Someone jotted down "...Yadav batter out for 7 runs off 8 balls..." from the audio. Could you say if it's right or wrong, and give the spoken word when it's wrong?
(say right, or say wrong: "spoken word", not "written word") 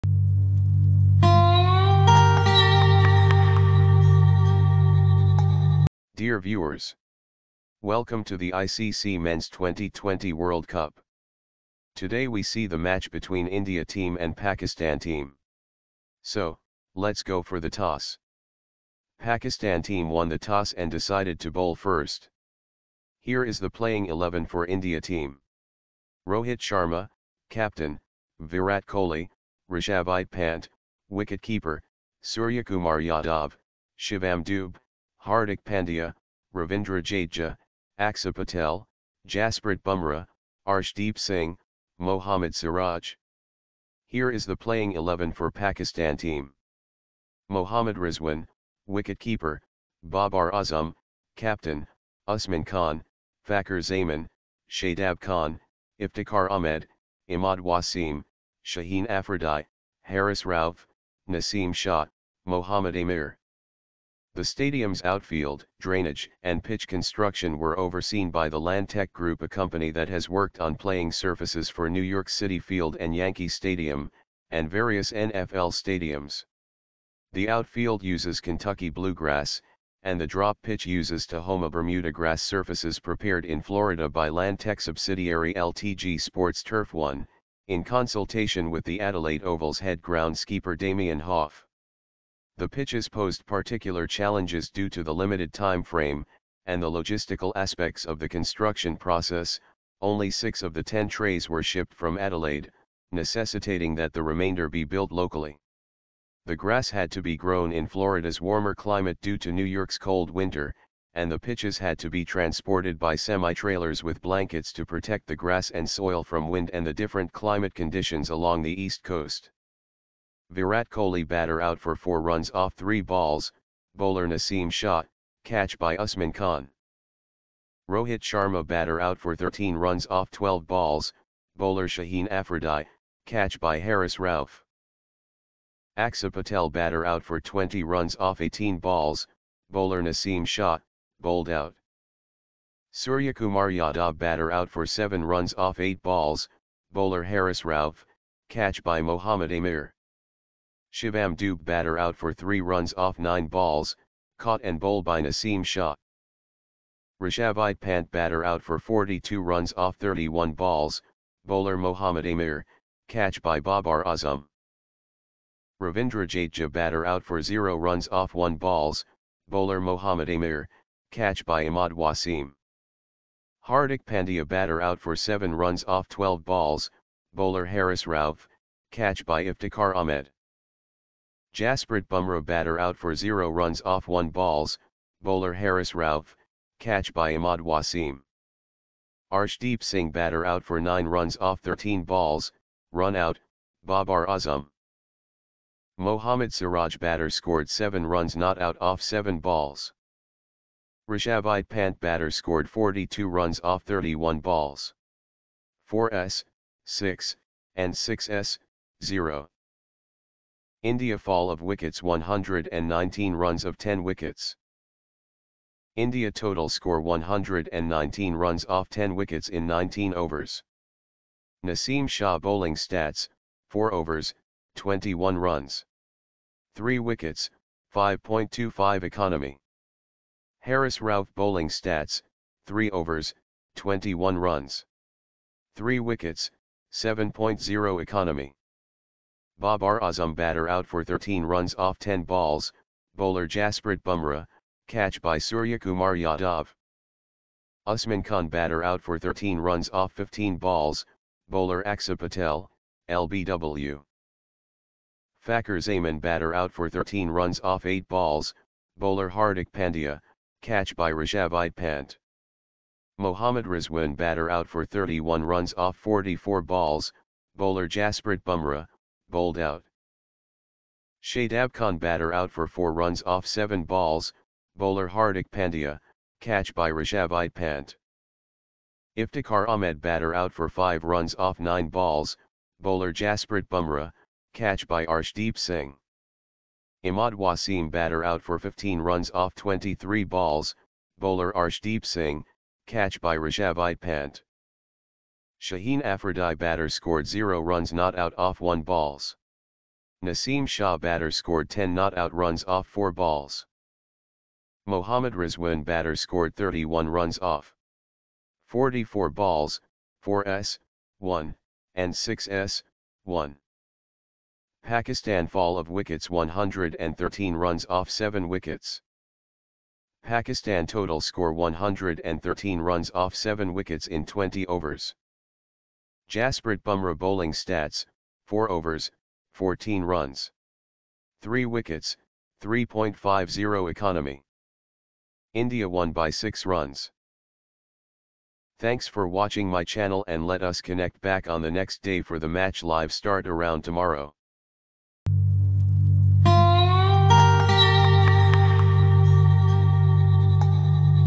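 right.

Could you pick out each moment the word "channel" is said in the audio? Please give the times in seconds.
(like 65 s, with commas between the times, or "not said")
339 s.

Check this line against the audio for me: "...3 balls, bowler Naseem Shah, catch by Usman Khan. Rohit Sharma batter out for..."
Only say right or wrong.
right.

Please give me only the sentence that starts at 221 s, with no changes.
Naseem Shah bowling stats, 4 overs, 21 runs.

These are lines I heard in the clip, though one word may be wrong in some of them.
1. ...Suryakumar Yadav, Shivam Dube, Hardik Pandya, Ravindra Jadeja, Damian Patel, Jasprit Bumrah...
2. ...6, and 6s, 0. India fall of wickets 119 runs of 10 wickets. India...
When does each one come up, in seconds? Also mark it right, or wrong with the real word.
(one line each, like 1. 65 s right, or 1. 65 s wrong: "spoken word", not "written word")
1. 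32 s wrong: "Axar", not "Damian"
2. 206 s right.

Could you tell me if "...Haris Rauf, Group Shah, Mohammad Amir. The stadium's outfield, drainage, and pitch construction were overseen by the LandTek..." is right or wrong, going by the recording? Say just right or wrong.
wrong.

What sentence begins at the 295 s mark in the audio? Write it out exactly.
Shaheen Afridi batter scored 0 runs not out off 1 balls.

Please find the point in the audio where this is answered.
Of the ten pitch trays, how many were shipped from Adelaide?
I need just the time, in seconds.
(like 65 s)
100 s.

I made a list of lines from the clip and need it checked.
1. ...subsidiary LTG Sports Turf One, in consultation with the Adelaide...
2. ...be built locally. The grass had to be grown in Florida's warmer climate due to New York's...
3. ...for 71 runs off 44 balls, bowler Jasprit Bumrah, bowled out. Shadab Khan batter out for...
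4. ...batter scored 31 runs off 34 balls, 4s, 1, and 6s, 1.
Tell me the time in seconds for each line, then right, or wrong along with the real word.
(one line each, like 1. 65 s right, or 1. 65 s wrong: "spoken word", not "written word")
1. 84 s right
2. 104 s right
3. 264 s wrong: "31", not "71"
4. 305 s wrong: "44", not "34".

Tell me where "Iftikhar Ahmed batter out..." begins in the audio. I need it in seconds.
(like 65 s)
279 s.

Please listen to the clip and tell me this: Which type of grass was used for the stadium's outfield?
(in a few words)
Kentucky bluegrass.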